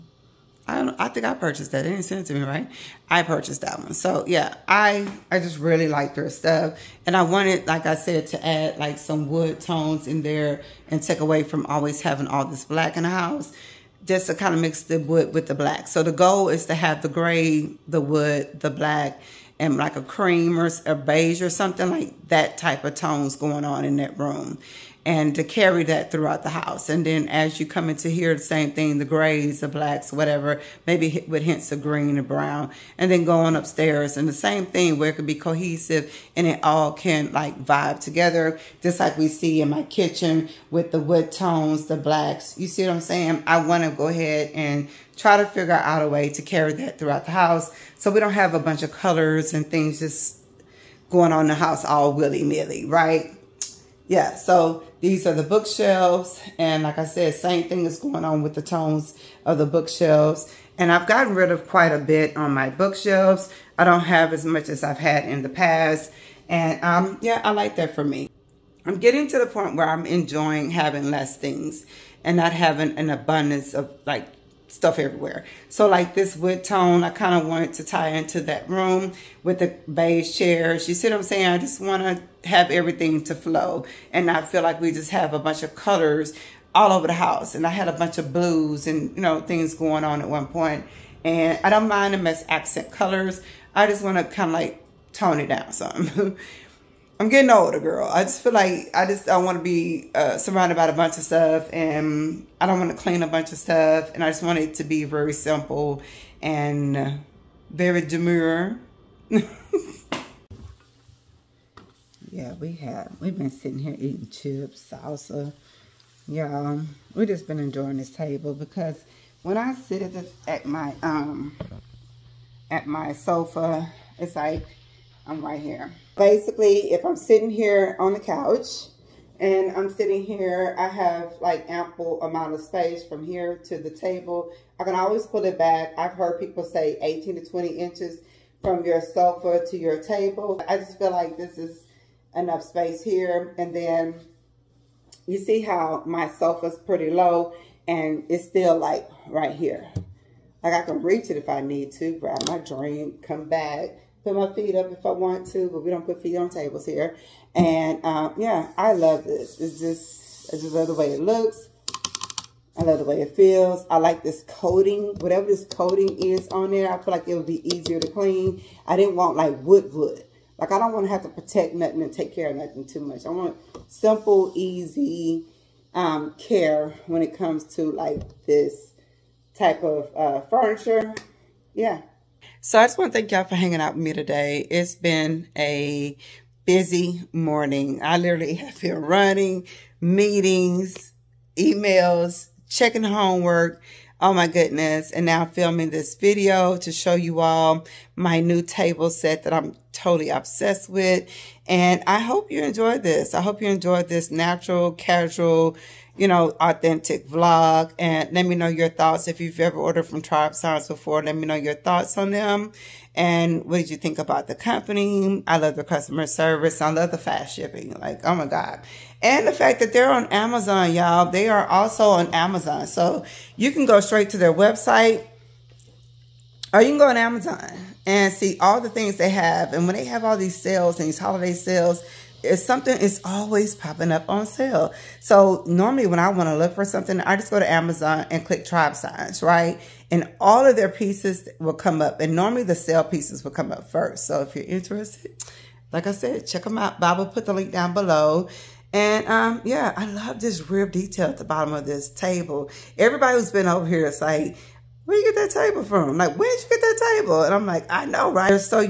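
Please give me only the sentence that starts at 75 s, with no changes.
So like this wood tone, I kind of wanted to tie into that room with the beige chairs.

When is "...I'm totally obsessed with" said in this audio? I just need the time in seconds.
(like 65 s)
199 s.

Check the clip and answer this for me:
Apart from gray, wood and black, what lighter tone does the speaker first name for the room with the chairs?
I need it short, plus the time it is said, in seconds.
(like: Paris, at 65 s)
cream, at 20 s.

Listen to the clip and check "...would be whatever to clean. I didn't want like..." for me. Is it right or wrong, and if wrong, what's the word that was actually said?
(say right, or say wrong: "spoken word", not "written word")
wrong: "easier", not "whatever".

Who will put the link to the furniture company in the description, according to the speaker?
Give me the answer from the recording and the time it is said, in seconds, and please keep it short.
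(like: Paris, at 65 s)
Bob, at 246 s.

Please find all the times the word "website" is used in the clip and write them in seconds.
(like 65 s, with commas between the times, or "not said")
224 s.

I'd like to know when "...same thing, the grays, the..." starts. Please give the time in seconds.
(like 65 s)
28 s.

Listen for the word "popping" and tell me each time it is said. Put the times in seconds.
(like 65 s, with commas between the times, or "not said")
233 s.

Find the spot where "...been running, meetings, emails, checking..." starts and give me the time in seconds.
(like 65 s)
188 s.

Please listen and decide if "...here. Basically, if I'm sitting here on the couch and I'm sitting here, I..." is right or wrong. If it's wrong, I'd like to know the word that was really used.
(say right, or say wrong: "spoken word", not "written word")
right.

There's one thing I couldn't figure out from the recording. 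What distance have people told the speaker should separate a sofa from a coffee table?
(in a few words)
18 to 20 inches.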